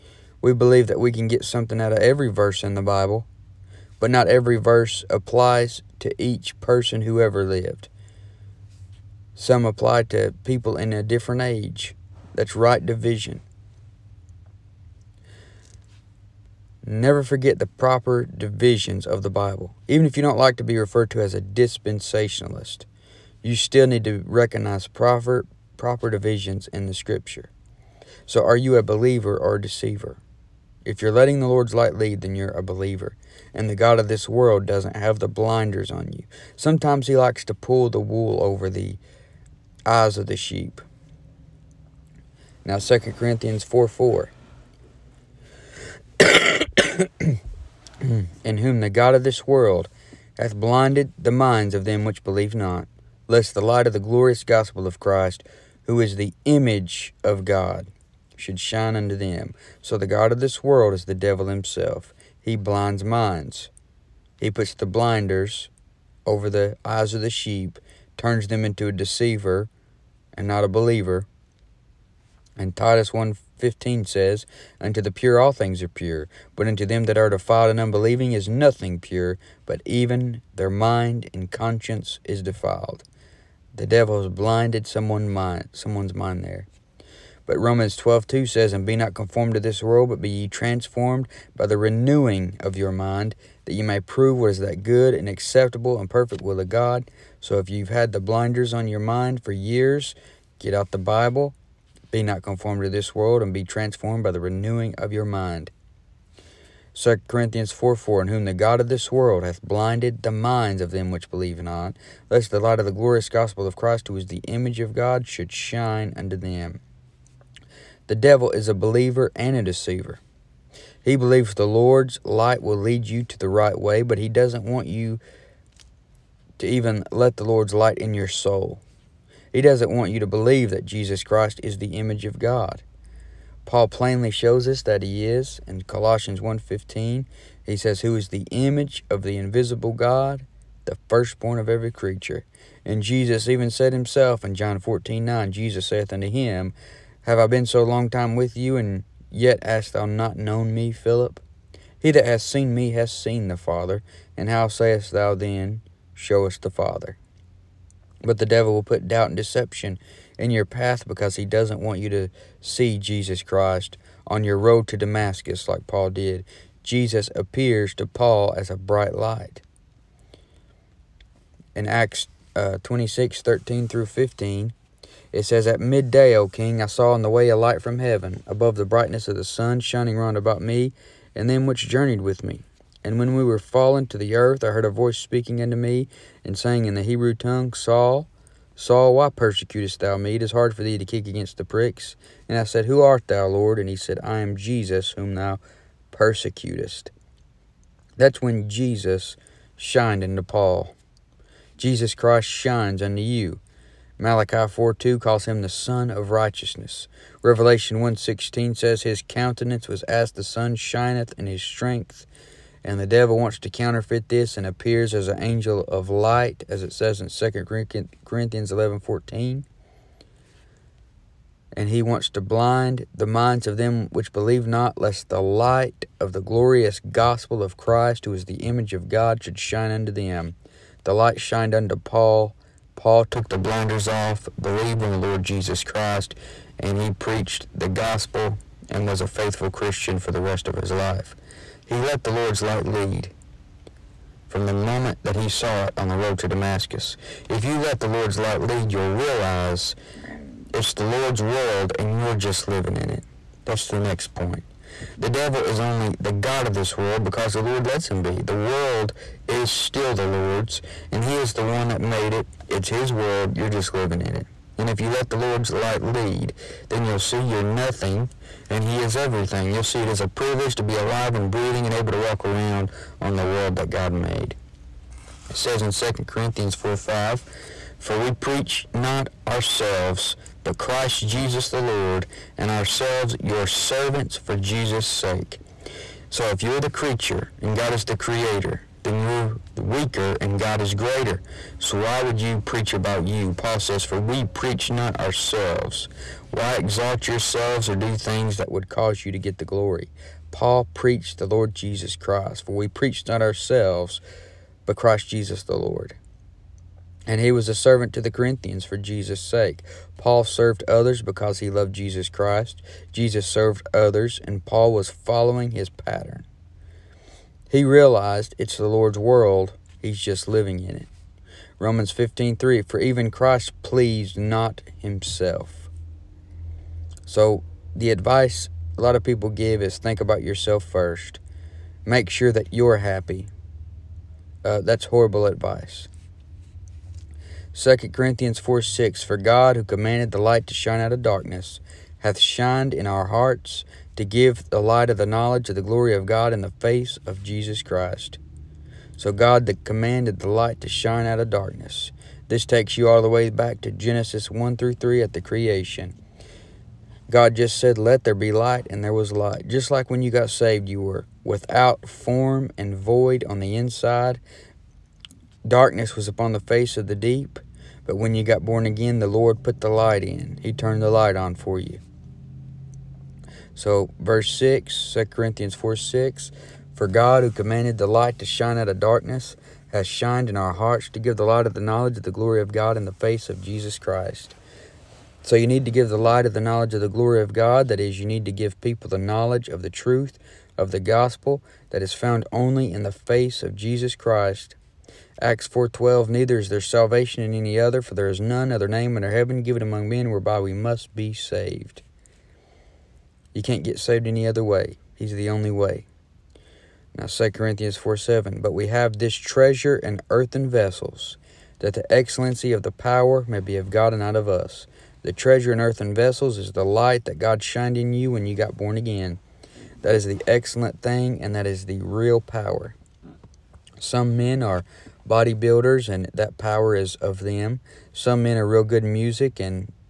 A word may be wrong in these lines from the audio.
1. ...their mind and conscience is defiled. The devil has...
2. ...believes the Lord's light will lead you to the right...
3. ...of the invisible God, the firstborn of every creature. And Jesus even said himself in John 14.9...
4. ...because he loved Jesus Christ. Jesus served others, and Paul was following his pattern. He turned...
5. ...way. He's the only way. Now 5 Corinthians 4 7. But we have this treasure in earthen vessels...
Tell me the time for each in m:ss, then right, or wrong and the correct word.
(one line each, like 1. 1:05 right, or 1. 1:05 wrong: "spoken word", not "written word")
1. 1:20 right
2. 2:01 right
3. 2:19 right
4. 5:11 wrong: "realized", not "turned"
5. 6:44 wrong: "2", not "5".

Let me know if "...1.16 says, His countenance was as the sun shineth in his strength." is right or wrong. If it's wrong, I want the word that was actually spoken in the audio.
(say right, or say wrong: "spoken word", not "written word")
right.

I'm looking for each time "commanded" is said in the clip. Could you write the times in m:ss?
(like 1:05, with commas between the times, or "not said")
5:39, 5:49, 6:17.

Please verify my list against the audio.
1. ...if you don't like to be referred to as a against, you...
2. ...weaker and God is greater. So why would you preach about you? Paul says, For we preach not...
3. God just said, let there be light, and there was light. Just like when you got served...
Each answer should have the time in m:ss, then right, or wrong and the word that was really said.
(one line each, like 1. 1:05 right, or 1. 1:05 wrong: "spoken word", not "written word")
1. 0:20 wrong: "dispensationalist", not "against"
2. 4:49 right
3. 5:57 wrong: "saved", not "served".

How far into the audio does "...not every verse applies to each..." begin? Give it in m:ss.
0:04.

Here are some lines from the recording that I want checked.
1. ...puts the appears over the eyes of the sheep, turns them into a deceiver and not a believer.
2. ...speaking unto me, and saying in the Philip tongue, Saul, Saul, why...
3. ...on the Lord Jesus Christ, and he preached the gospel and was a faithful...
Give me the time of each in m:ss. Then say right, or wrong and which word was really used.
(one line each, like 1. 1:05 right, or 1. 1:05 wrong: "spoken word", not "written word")
1. 1:04 wrong: "blinders", not "appears"
2. 3:05 wrong: "Hebrew", not "Philip"
3. 3:55 right.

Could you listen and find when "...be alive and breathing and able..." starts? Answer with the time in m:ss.
4:30.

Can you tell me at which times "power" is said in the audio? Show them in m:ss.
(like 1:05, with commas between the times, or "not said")
6:52, 7:02, 7:06.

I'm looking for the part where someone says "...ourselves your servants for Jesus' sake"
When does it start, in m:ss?
4:42.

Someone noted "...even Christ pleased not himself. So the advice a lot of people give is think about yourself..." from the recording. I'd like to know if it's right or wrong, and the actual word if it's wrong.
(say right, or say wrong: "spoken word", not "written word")
right.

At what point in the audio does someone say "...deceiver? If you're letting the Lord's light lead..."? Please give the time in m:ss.
0:29.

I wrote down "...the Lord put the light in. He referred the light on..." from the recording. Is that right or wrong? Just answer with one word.
wrong.